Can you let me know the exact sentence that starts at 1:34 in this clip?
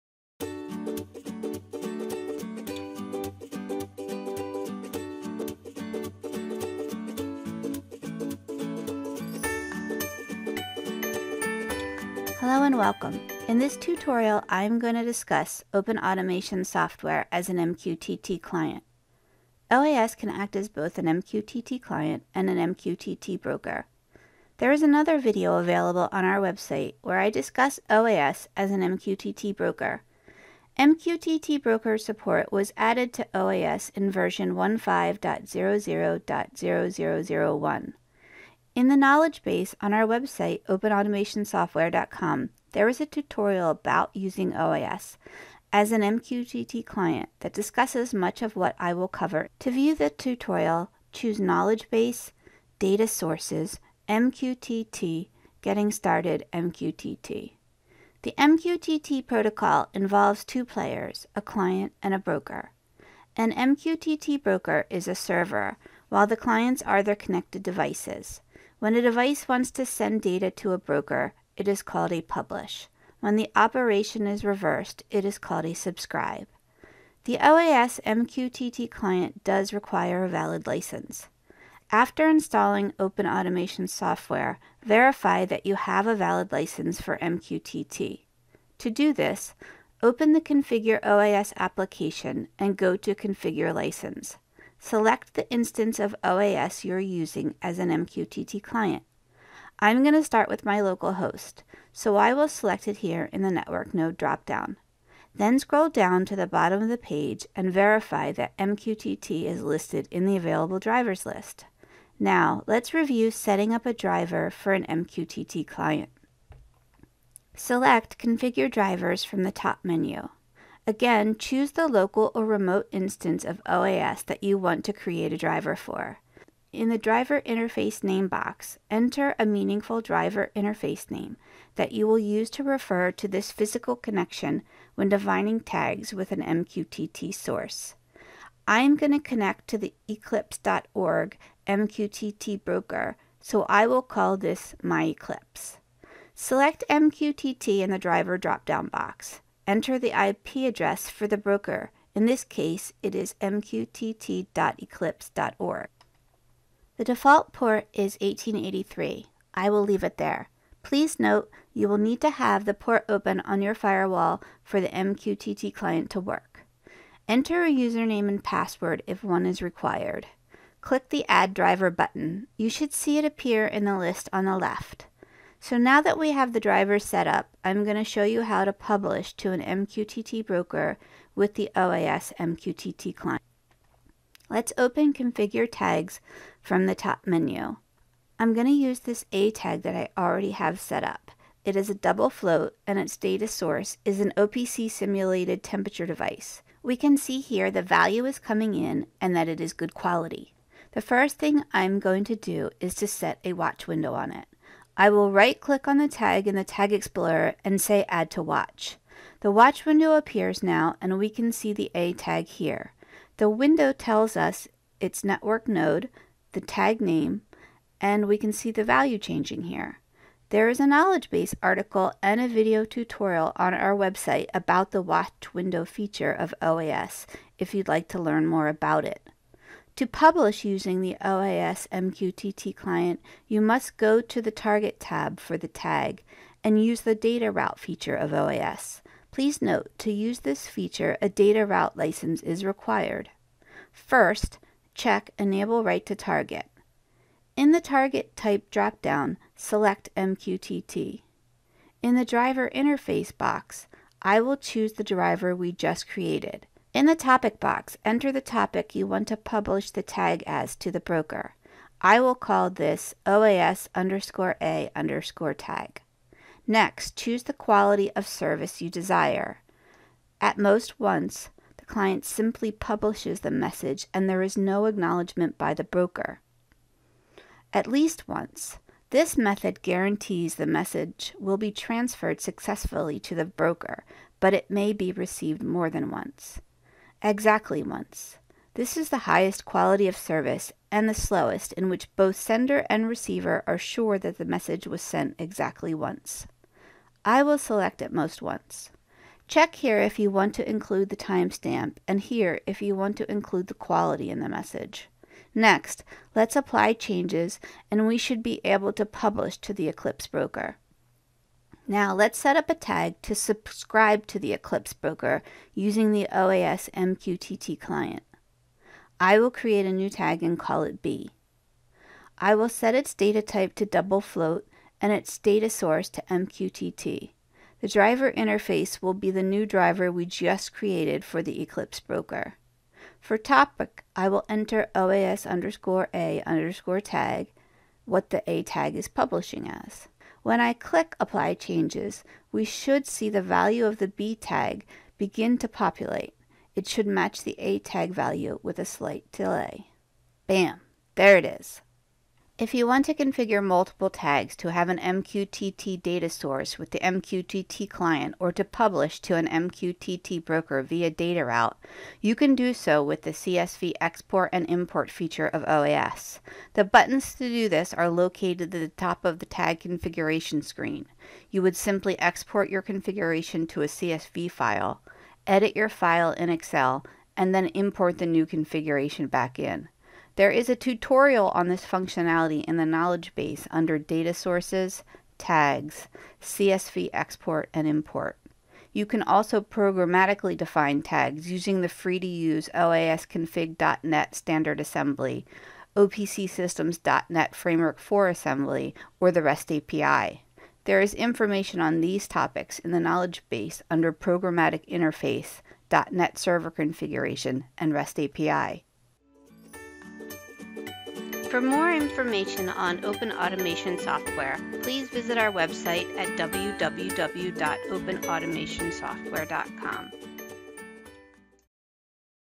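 Select the instance of OAS you're using as an MQTT client.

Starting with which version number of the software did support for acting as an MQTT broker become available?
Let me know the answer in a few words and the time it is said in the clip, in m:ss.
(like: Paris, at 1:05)
15.00.0001, at 0:34.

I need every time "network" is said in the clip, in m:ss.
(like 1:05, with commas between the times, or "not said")
1:43, 3:35.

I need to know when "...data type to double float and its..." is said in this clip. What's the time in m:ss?
5:23.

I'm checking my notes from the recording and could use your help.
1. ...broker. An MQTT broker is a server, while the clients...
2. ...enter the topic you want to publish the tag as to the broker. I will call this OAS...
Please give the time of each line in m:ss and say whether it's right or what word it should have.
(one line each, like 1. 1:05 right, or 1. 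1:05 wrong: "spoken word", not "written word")
1. 1:02 right
2. 4:18 right.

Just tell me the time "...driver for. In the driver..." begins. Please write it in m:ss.
2:05.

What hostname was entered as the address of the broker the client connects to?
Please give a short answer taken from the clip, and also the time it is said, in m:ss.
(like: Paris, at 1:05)
mqtt.eclipse.org, at 2:33.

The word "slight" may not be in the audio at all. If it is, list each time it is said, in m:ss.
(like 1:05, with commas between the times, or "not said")
5:48.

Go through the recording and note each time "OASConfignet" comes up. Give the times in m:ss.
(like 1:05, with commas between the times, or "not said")
6:32.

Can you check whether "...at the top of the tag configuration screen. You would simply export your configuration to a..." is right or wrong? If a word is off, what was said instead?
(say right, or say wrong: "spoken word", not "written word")
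right.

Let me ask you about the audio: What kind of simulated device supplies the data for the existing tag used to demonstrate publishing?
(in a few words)
OPC simulated temperature device.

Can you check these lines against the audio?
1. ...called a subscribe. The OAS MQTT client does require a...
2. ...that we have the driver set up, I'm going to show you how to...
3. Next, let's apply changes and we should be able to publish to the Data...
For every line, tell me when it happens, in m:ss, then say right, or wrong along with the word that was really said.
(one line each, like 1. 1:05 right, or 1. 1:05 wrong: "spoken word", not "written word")
1. 1:15 right
2. 2:56 right
3. 5:05 wrong: "Eclipse", not "Data".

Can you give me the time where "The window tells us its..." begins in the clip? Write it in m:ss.
3:33.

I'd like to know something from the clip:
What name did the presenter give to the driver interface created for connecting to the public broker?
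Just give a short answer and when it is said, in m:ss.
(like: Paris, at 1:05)
my eclipse, at 2:24.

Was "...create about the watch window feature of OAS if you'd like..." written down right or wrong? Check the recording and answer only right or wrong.
wrong.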